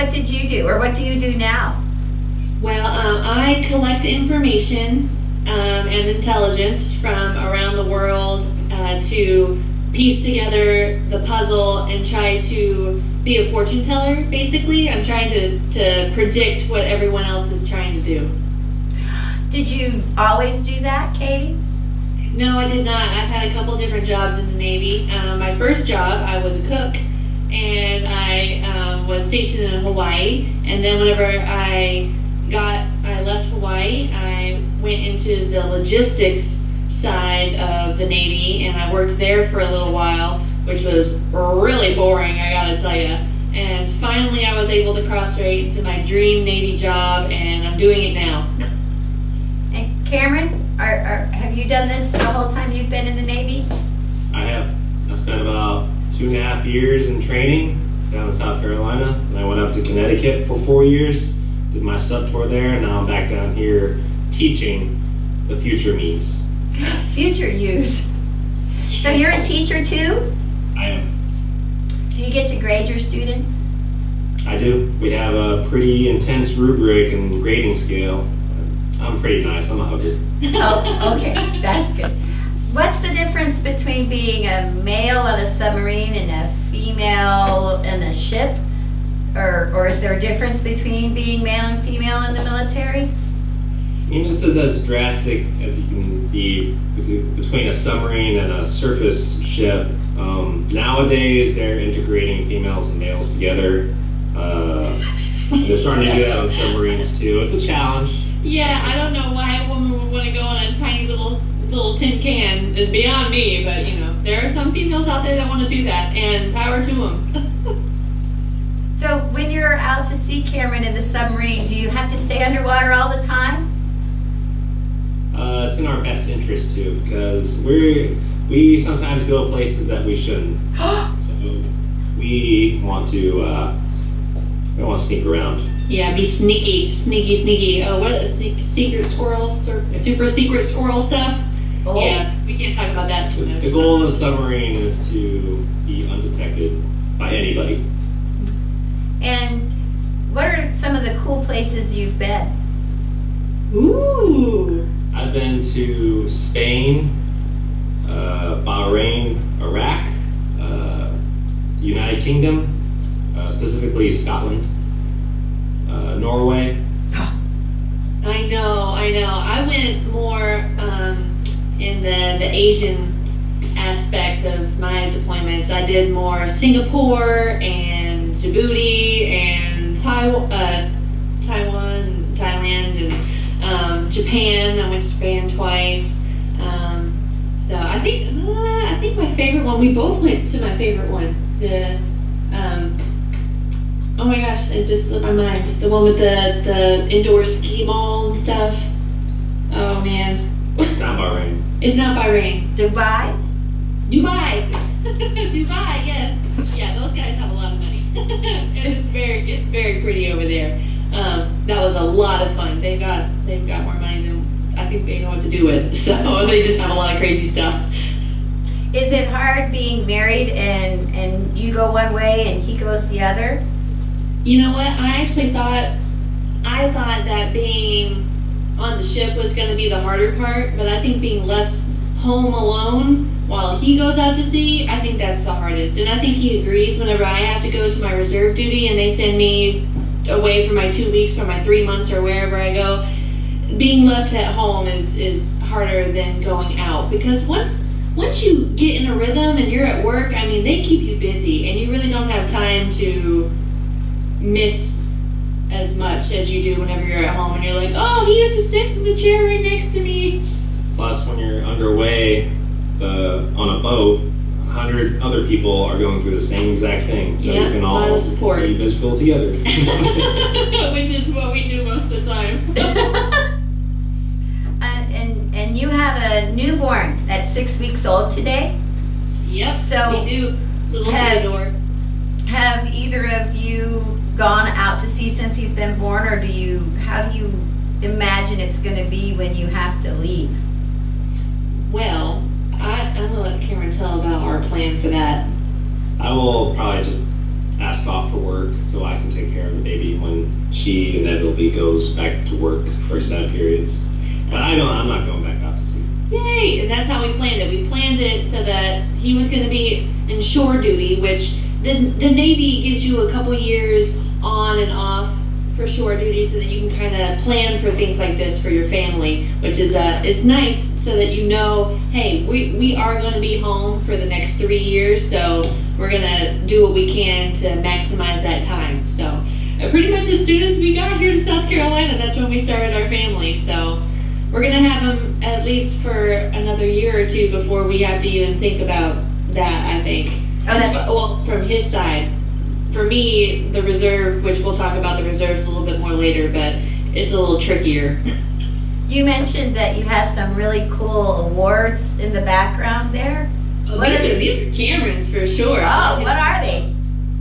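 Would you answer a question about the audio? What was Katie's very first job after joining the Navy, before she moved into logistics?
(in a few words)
Cook.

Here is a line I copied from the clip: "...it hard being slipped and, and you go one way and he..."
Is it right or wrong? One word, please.
wrong.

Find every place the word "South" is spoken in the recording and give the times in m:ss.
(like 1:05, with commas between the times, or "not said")
0:58, 5:31.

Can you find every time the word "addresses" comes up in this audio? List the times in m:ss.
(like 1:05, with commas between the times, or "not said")
not said.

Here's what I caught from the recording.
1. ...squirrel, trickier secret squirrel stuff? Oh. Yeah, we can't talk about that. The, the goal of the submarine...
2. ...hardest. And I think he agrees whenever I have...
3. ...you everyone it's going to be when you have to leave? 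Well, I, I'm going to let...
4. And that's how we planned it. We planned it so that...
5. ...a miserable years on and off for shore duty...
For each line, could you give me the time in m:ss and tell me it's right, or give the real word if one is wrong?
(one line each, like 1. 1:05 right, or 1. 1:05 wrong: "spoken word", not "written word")
1. 2:19 wrong: "super", not "trickier"
2. 3:55 right
3. 4:47 wrong: "imagine", not "everyone"
4. 5:06 right
5. 5:13 wrong: "couple", not "miserable".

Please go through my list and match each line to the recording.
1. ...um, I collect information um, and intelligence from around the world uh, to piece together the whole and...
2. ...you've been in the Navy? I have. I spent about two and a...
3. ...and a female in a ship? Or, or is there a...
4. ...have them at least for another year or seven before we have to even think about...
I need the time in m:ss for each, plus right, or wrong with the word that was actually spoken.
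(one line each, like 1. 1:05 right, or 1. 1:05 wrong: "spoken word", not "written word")
1. 0:02 wrong: "puzzle", not "whole"
2. 0:52 right
3. 1:26 right
4. 5:34 wrong: "two", not "seven".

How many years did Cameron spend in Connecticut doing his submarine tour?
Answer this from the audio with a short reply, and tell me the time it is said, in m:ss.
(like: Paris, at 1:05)
4, at 1:00.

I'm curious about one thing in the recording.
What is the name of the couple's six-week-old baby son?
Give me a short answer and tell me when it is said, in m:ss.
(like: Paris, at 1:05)
Theodore, at 4:41.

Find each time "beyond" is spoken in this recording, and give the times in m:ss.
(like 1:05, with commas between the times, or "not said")
1:52.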